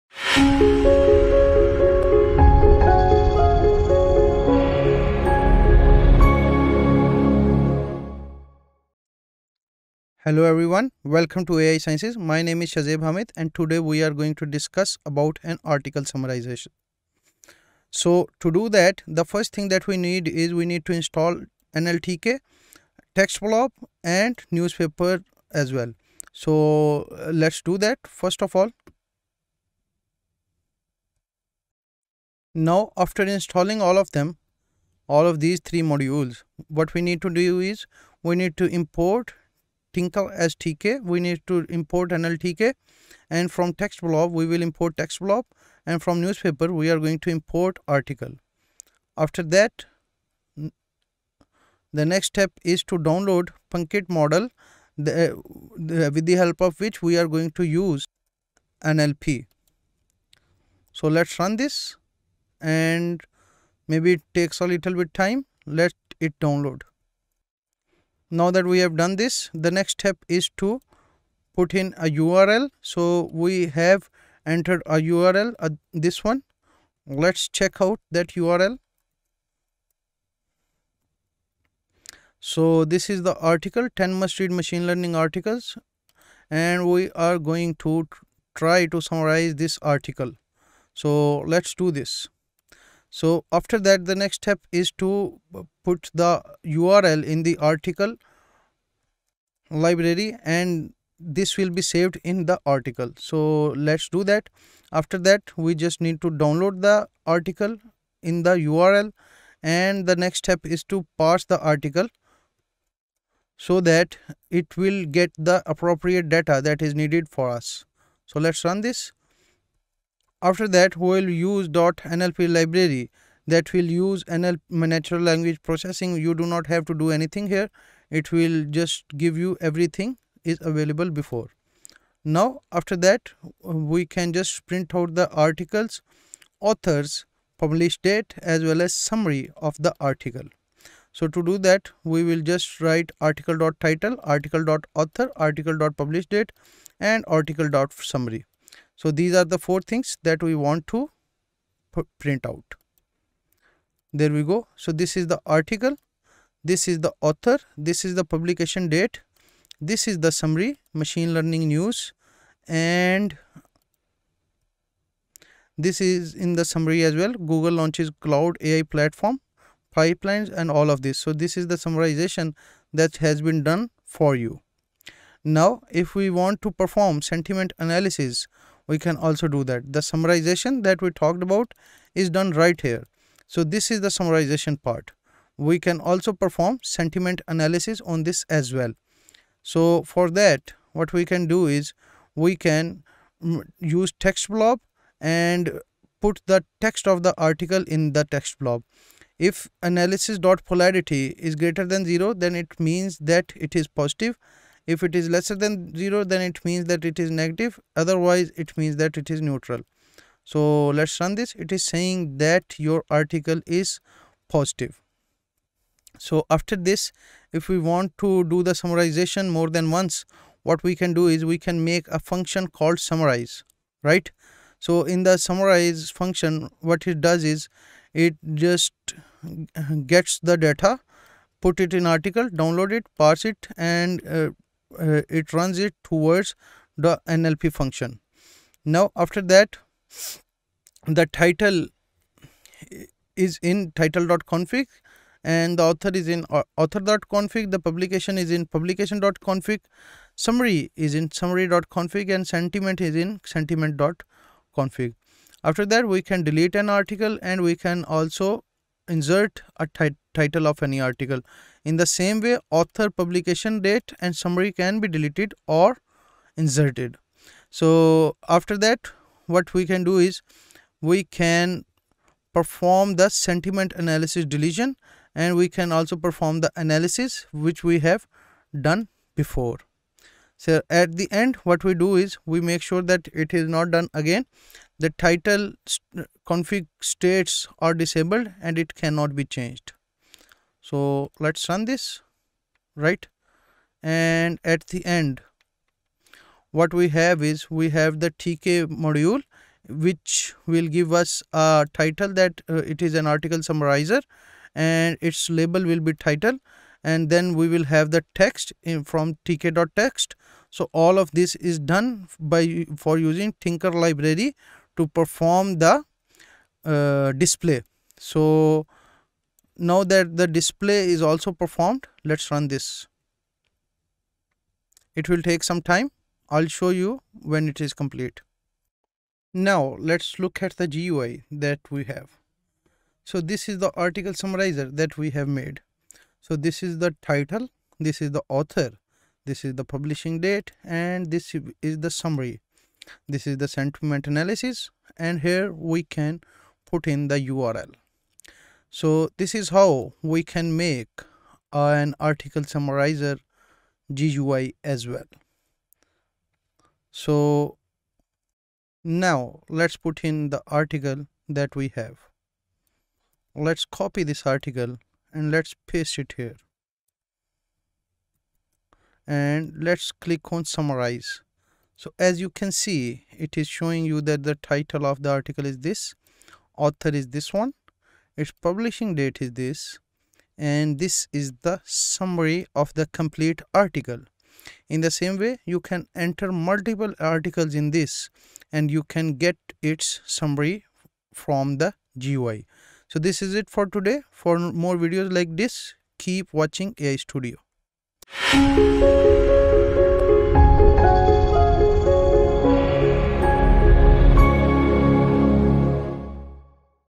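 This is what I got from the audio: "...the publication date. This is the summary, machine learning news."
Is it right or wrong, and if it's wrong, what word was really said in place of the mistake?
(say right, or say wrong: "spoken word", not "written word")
right.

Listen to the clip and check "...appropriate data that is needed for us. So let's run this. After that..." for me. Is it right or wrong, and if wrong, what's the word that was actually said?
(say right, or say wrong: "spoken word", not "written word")
right.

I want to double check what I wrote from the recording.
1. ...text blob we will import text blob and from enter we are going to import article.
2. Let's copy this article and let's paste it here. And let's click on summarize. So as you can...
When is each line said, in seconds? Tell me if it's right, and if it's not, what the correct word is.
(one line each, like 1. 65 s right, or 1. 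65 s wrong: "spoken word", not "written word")
1. 43 s wrong: "newspaper", not "enter"
2. 363 s right.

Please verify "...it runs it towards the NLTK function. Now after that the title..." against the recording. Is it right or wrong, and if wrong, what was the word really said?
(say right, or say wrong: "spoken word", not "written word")
wrong: "NLP", not "NLTK".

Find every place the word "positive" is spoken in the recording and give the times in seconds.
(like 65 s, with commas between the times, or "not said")
203 s, 214 s.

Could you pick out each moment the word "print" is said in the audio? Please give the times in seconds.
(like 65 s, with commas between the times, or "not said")
134 s, 152 s.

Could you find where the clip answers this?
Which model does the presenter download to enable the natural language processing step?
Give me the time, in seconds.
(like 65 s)
53 s.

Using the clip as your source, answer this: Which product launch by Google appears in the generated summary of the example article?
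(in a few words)
Cloud AI platform pipelines.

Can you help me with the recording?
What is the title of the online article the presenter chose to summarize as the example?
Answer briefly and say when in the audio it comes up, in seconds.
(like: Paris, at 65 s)
10 must read machine learning articles, at 83 s.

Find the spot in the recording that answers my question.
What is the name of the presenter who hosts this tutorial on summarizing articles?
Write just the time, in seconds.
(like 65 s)
12 s.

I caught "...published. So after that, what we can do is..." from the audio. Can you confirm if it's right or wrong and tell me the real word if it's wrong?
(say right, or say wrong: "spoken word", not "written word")
wrong: "inserted", not "published".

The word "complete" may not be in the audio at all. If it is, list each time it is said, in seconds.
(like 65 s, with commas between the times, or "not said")
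327 s, 383 s.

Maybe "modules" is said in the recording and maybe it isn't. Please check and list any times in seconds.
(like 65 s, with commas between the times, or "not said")
35 s, 299 s.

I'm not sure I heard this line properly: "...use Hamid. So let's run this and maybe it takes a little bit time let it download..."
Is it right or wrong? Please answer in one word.
wrong.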